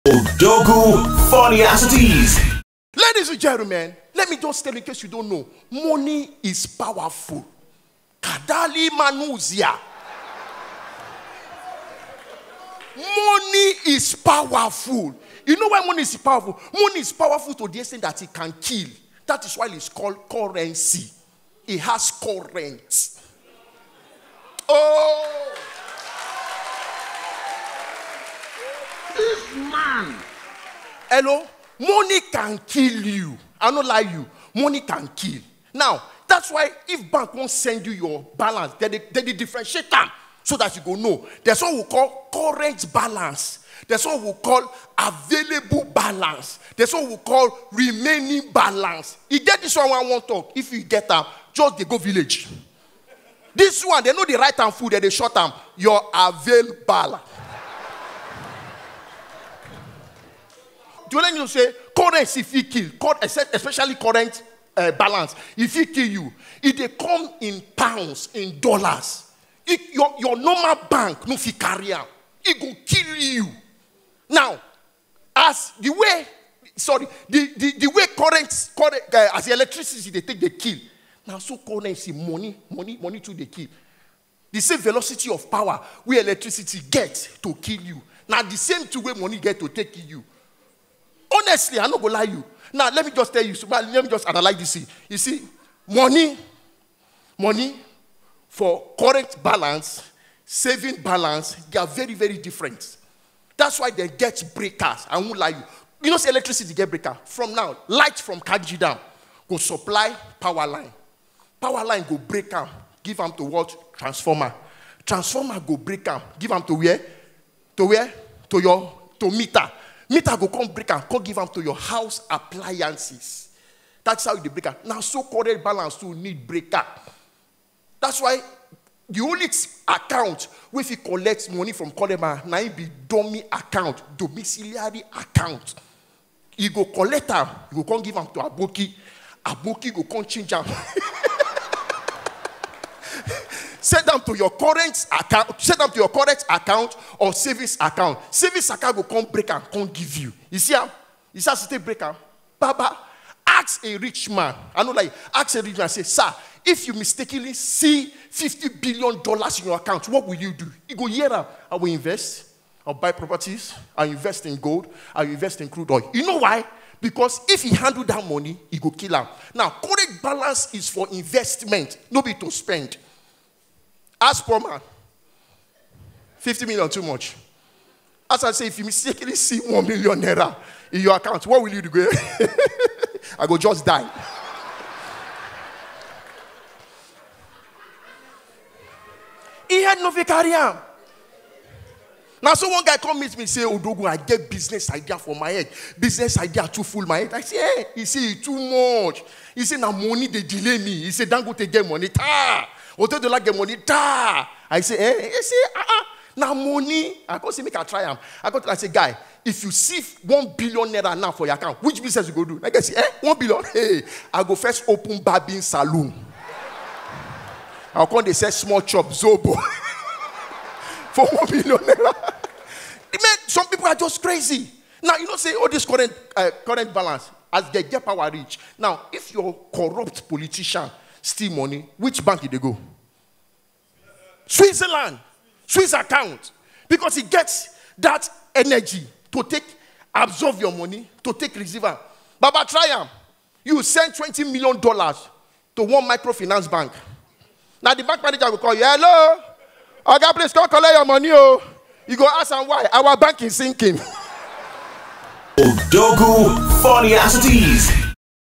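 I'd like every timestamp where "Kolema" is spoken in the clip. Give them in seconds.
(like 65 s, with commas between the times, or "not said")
131 s.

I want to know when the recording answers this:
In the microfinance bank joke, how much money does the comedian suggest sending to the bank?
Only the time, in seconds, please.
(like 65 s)
244 s.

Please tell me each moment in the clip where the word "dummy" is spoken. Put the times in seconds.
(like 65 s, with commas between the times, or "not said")
133 s.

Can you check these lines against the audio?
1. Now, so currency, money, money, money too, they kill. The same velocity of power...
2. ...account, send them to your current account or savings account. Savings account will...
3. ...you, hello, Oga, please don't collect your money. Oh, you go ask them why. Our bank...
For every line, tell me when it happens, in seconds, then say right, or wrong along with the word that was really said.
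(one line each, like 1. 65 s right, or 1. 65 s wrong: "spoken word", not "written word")
1. 81 s right
2. 145 s right
3. 248 s right.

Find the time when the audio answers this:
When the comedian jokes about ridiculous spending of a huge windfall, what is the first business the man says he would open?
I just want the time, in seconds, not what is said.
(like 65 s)
215 s.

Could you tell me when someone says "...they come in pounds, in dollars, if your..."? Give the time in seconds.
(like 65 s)
66 s.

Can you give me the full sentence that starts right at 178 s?
As I say, if you mistakenly see 1 million naira in your account, what will you do?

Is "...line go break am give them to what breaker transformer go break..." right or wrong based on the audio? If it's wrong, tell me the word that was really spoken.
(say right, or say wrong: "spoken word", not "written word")
wrong: "transformer", not "breaker".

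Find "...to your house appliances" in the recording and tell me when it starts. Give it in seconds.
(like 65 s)
121 s.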